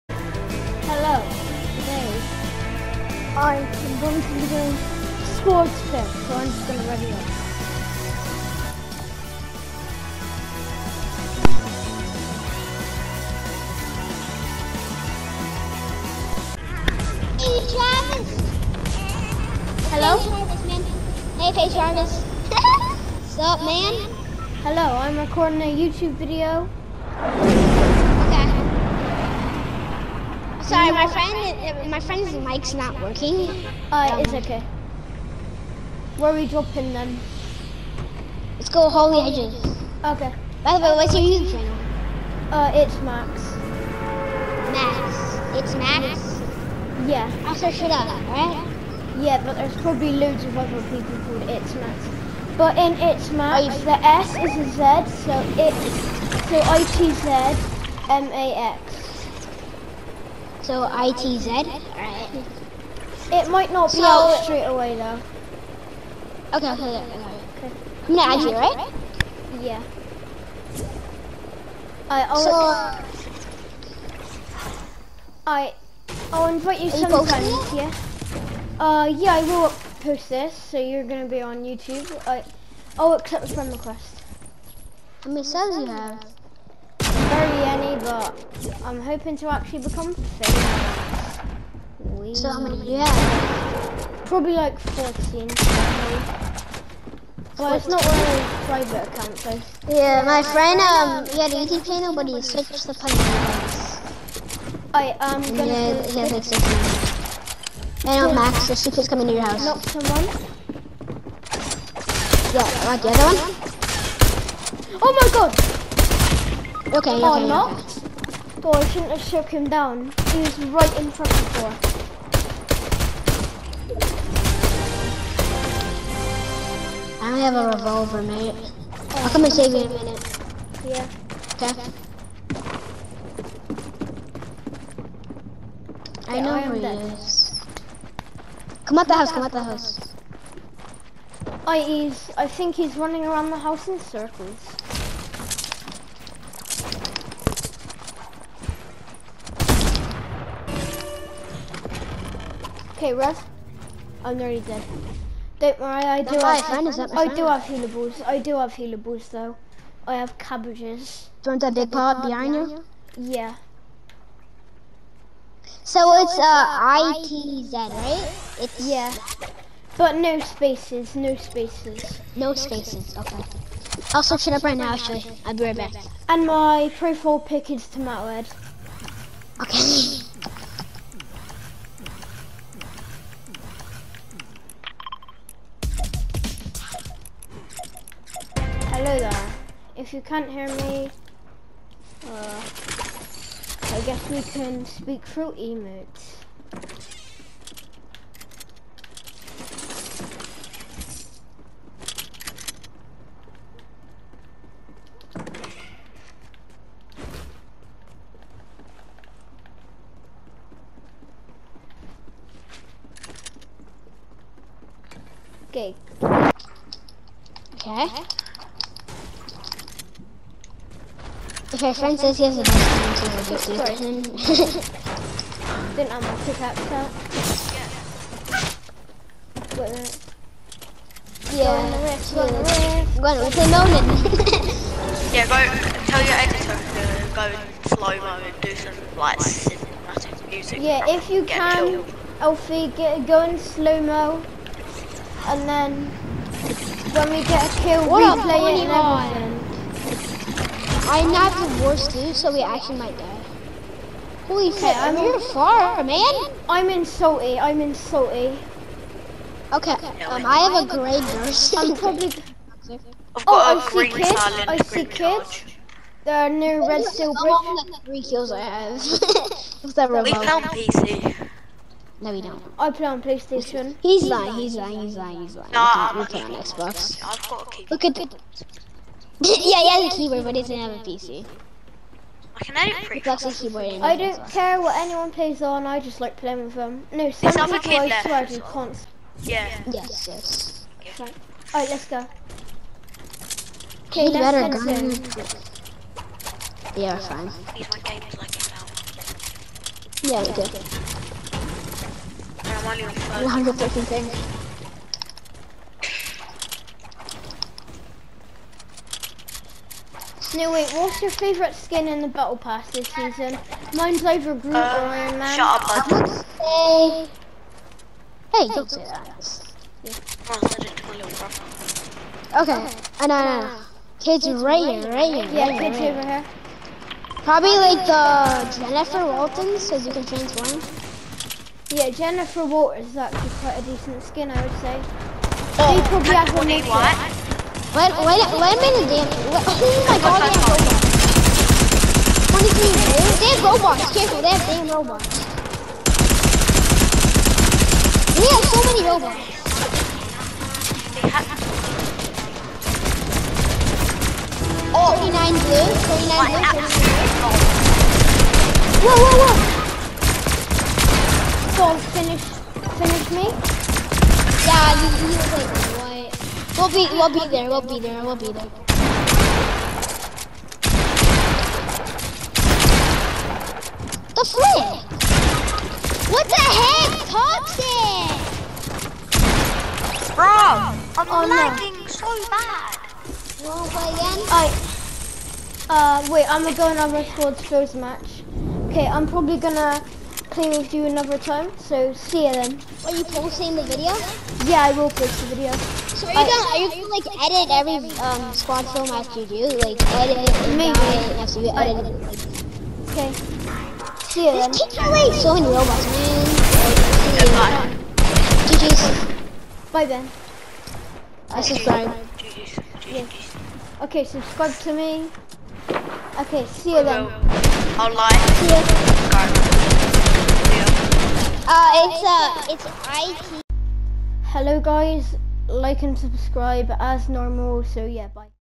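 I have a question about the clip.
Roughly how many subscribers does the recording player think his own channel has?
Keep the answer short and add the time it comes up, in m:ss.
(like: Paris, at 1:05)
14, at 1:34.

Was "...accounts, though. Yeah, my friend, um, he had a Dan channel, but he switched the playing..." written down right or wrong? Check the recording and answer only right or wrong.
wrong.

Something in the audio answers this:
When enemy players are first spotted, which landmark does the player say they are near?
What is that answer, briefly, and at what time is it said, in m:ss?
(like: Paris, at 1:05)
Red Steel Bridge, at 4:26.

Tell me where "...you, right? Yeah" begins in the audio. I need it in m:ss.
1:08.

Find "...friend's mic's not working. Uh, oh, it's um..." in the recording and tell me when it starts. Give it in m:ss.
0:31.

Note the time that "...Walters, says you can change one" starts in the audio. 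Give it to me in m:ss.
5:29.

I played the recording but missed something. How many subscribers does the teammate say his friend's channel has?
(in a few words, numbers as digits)
16.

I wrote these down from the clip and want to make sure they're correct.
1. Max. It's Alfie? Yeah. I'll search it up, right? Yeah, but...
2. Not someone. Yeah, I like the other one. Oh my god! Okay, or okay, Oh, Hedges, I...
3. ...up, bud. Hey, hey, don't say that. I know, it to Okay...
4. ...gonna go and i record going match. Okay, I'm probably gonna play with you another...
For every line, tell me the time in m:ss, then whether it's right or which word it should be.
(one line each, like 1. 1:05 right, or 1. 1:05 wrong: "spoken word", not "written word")
1. 0:44 wrong: "Max", not "Alfie"
2. 1:49 wrong: "Boy", not "Hedges"
3. 5:15 right
4. 6:26 right.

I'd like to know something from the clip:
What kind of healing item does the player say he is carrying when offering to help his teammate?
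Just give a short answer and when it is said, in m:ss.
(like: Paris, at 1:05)
Cabbages, at 2:40.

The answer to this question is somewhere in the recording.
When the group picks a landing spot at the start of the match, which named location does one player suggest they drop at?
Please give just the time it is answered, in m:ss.
0:38.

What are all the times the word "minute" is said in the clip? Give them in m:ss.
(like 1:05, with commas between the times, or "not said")
2:09, 5:38.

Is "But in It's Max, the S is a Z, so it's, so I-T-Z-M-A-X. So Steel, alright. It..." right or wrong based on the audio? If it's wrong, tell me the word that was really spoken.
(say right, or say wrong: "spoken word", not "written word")
wrong: "ITZ", not "Steel".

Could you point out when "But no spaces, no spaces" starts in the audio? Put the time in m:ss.
2:49.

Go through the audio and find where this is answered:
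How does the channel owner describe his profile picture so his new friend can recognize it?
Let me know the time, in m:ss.
2:57.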